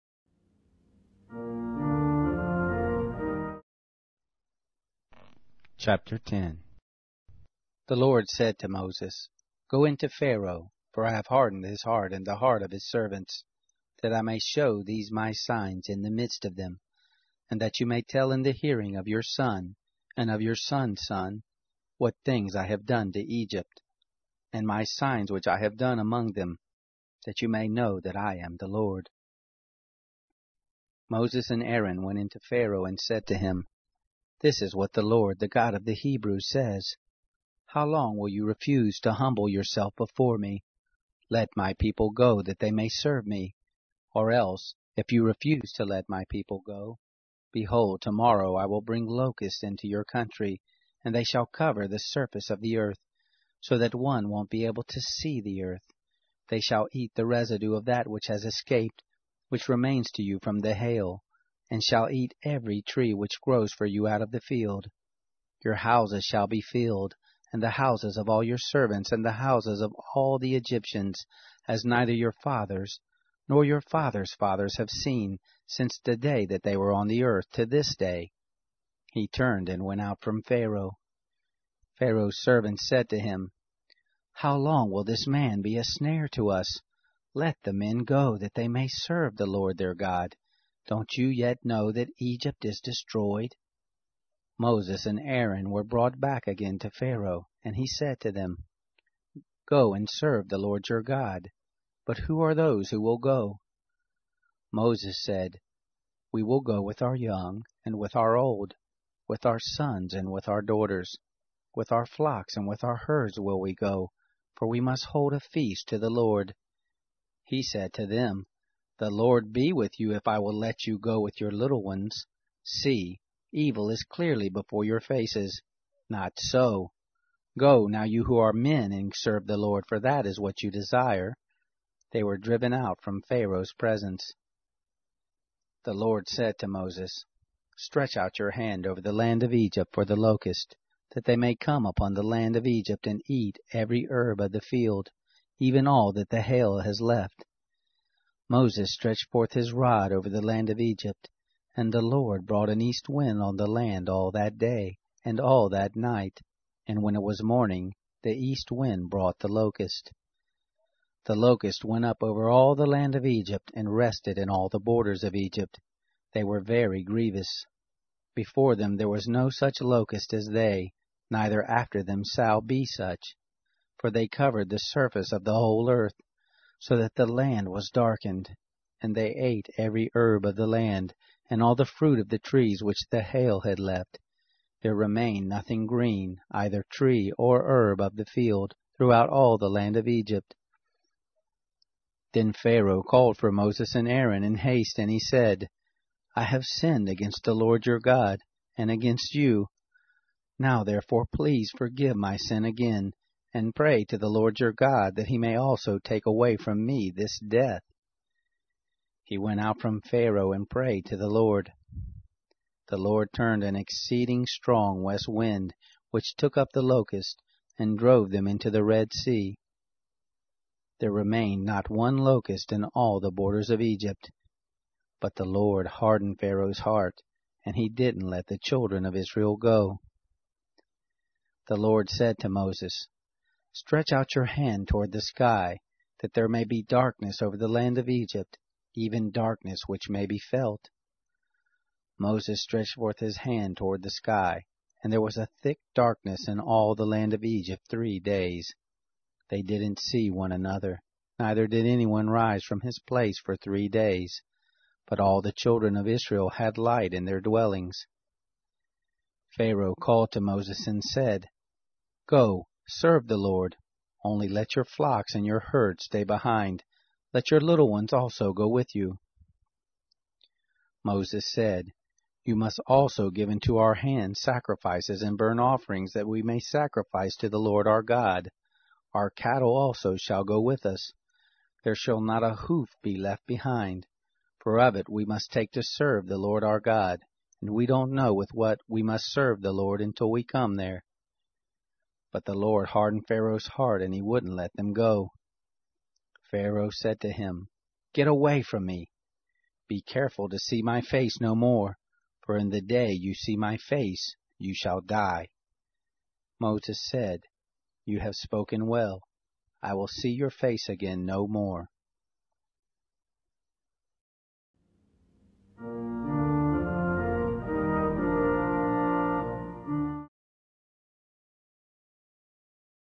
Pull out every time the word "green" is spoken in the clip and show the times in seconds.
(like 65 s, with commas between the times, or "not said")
185 s.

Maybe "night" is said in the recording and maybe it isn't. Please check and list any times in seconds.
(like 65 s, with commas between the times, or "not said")
155 s.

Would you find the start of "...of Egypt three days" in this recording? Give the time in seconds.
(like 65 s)
247 s.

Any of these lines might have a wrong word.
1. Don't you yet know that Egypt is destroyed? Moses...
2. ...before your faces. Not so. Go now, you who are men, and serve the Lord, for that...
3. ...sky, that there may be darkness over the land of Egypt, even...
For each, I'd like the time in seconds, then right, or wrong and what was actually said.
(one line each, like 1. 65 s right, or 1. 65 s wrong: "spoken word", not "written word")
1. 90 s right
2. 124 s right
3. 235 s right.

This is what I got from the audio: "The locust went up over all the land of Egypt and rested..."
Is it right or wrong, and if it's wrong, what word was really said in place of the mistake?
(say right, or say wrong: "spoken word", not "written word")
right.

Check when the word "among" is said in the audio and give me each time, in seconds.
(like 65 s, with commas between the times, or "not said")
25 s.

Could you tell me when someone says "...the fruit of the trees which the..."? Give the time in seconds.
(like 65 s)
181 s.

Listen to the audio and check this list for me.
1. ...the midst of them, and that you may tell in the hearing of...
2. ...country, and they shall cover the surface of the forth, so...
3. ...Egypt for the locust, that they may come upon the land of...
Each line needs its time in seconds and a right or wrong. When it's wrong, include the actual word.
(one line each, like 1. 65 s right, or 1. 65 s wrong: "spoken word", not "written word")
1. 16 s right
2. 50 s wrong: "earth", not "forth"
3. 139 s right.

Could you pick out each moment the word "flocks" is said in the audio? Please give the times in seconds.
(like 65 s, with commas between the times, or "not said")
112 s, 264 s.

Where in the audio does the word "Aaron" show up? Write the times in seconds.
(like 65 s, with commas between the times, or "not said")
31 s, 95 s, 194 s.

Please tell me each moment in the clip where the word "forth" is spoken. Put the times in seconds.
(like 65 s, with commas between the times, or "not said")
149 s, 242 s.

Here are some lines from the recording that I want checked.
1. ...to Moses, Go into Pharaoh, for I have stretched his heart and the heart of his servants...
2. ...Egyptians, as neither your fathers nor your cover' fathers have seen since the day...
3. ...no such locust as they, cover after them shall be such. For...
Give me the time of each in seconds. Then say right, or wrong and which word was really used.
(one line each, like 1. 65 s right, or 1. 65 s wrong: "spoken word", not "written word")
1. 8 s wrong: "hardened", not "stretched"
2. 70 s wrong: "fathers", not "cover"
3. 169 s wrong: "neither", not "cover".